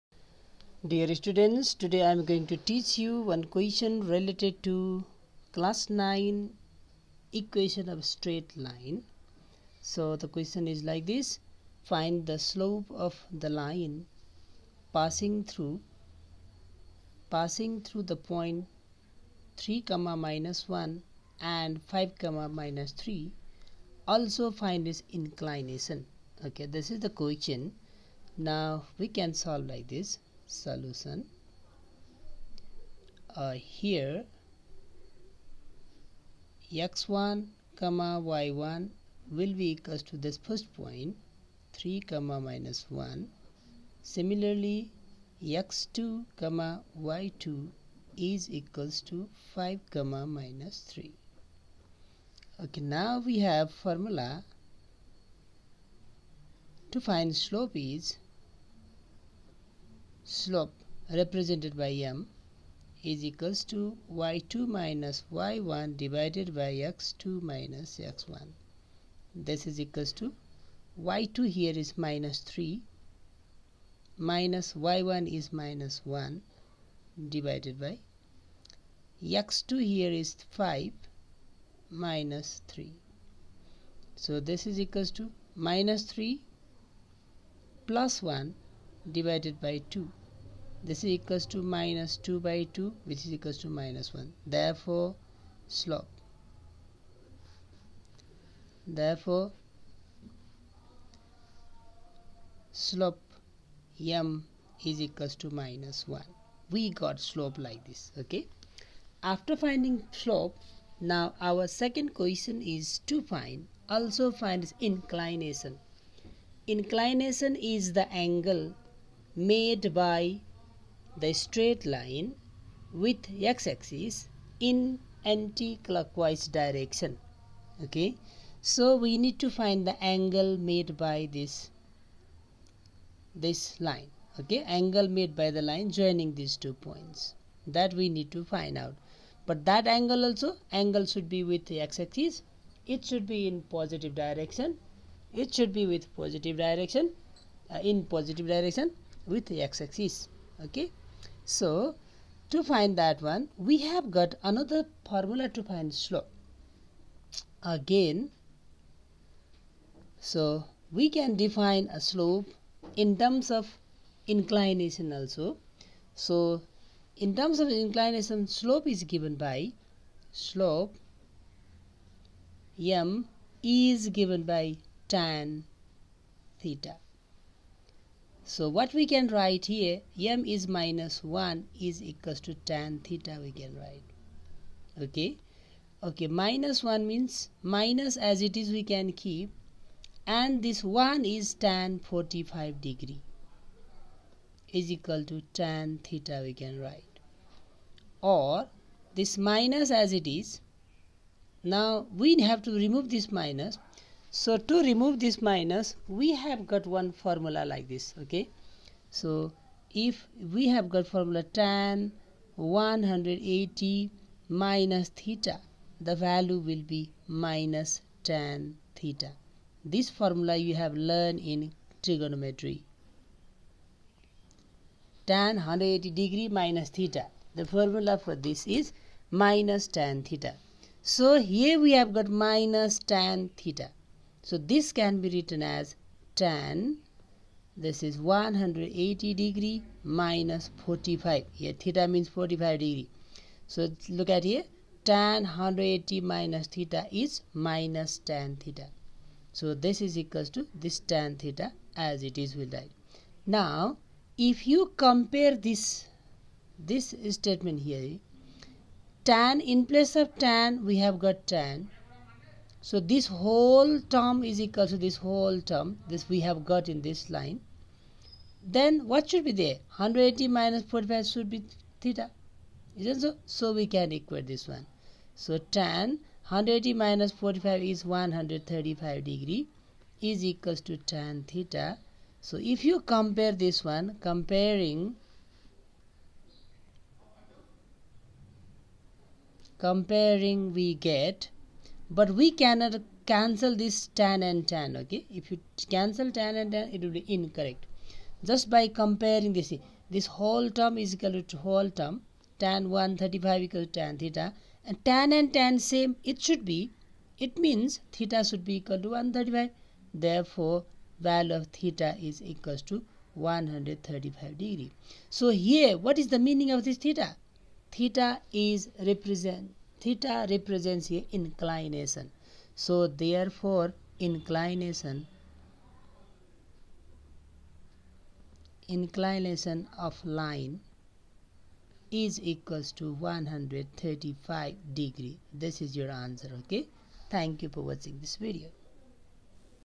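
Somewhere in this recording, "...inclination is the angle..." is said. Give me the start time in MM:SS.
01:56.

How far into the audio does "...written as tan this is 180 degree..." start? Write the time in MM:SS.
03:55.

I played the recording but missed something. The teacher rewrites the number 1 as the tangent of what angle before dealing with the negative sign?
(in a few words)
45 degrees.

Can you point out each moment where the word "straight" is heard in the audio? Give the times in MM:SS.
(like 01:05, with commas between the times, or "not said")
00:08, 02:01.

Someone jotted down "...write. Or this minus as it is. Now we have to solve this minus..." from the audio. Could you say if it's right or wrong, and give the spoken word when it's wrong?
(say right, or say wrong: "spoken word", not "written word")
wrong: "remove", not "solve".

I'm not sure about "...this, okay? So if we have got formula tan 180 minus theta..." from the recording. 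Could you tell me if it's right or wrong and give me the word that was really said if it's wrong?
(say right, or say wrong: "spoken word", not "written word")
right.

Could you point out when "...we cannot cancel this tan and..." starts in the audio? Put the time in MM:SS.
04:52.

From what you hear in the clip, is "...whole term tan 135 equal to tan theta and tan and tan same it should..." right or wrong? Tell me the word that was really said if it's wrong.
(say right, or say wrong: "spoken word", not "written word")
right.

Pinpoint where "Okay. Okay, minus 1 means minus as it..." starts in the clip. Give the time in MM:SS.
03:05.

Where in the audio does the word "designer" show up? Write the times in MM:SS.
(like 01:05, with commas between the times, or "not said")
not said.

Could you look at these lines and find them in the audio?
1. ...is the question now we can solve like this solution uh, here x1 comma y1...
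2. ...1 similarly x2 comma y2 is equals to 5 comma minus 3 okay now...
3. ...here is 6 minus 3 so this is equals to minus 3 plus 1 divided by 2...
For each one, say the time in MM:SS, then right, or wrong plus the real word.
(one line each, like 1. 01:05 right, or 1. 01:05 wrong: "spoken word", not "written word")
1. 00:26 right
2. 00:42 right
3. 01:19 wrong: "5", not "6".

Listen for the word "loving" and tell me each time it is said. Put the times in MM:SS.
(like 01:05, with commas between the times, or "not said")
not said.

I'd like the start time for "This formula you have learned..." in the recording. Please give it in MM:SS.
03:39.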